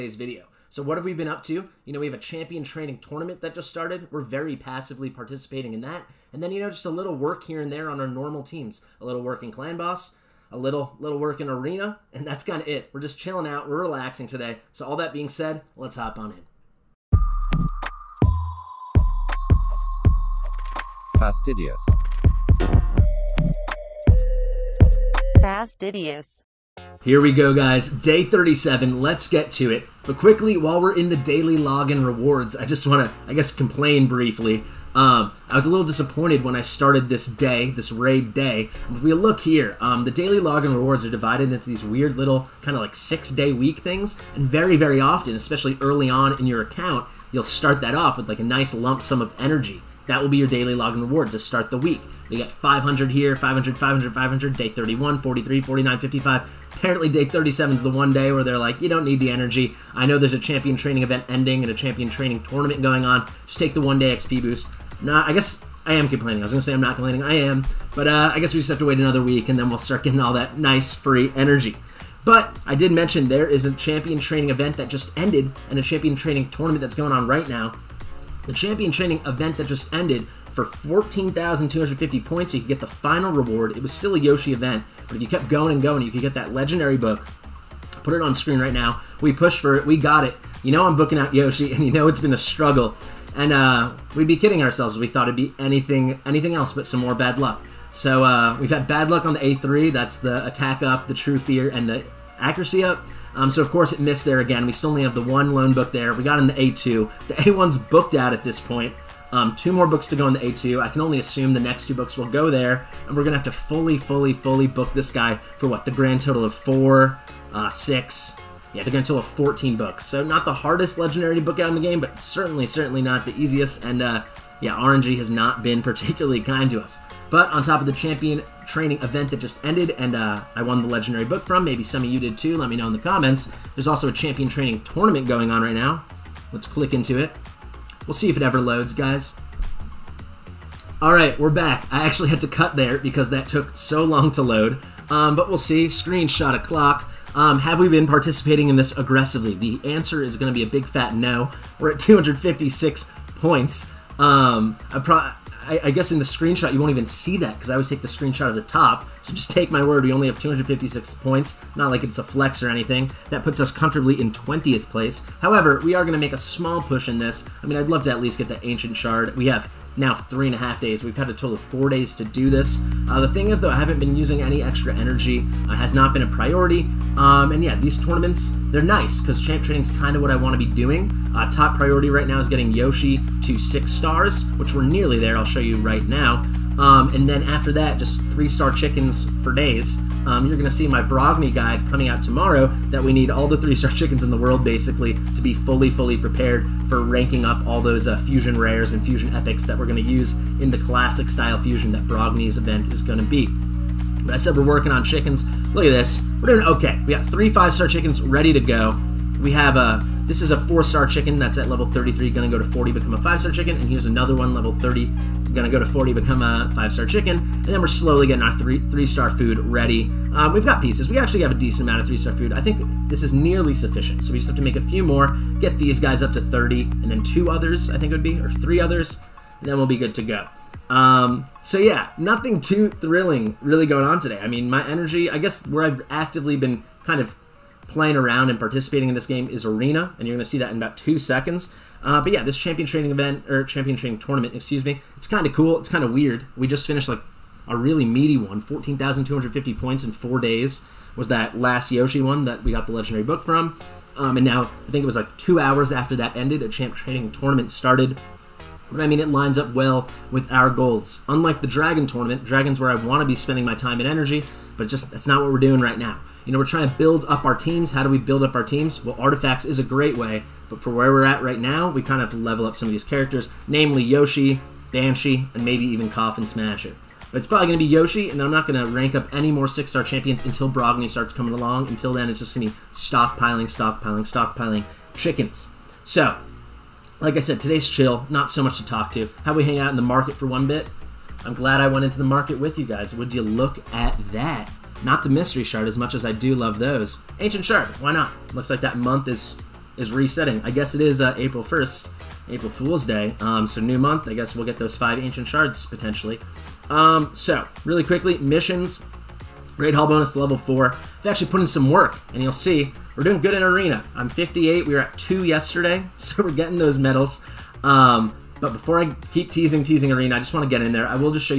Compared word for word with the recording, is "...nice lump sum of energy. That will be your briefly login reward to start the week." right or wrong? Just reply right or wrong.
wrong.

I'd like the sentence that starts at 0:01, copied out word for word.
You know, we have a champion training tournament that just started.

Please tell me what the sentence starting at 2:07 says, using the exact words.
But on top of the champion training event that just ended, and uh, I won the legendary book from.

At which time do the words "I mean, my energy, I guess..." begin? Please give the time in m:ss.
3:54.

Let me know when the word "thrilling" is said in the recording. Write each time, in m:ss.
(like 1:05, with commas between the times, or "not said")
3:52.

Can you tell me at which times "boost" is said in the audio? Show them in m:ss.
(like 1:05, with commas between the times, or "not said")
1:04.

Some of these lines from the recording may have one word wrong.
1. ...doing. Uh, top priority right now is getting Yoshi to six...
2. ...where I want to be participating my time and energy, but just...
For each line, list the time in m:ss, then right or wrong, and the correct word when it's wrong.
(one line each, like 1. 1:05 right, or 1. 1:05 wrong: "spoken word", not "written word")
1. 3:00 right
2. 4:22 wrong: "spending", not "participating".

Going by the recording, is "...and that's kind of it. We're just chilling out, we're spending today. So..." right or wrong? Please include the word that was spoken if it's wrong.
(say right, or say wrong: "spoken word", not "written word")
wrong: "relaxing", not "spending".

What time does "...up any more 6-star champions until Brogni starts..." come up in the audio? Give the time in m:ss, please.
4:39.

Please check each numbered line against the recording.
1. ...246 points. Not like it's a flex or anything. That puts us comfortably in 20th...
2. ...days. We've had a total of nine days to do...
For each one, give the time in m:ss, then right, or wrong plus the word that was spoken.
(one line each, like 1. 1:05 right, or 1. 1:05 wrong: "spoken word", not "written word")
1. 2:40 wrong: "256", not "246"
2. 2:50 wrong: "four", not "nine".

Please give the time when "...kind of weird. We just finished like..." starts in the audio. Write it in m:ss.
4:05.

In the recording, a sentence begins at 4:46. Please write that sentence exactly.
So, like I said, today's chill, not so much to talk to.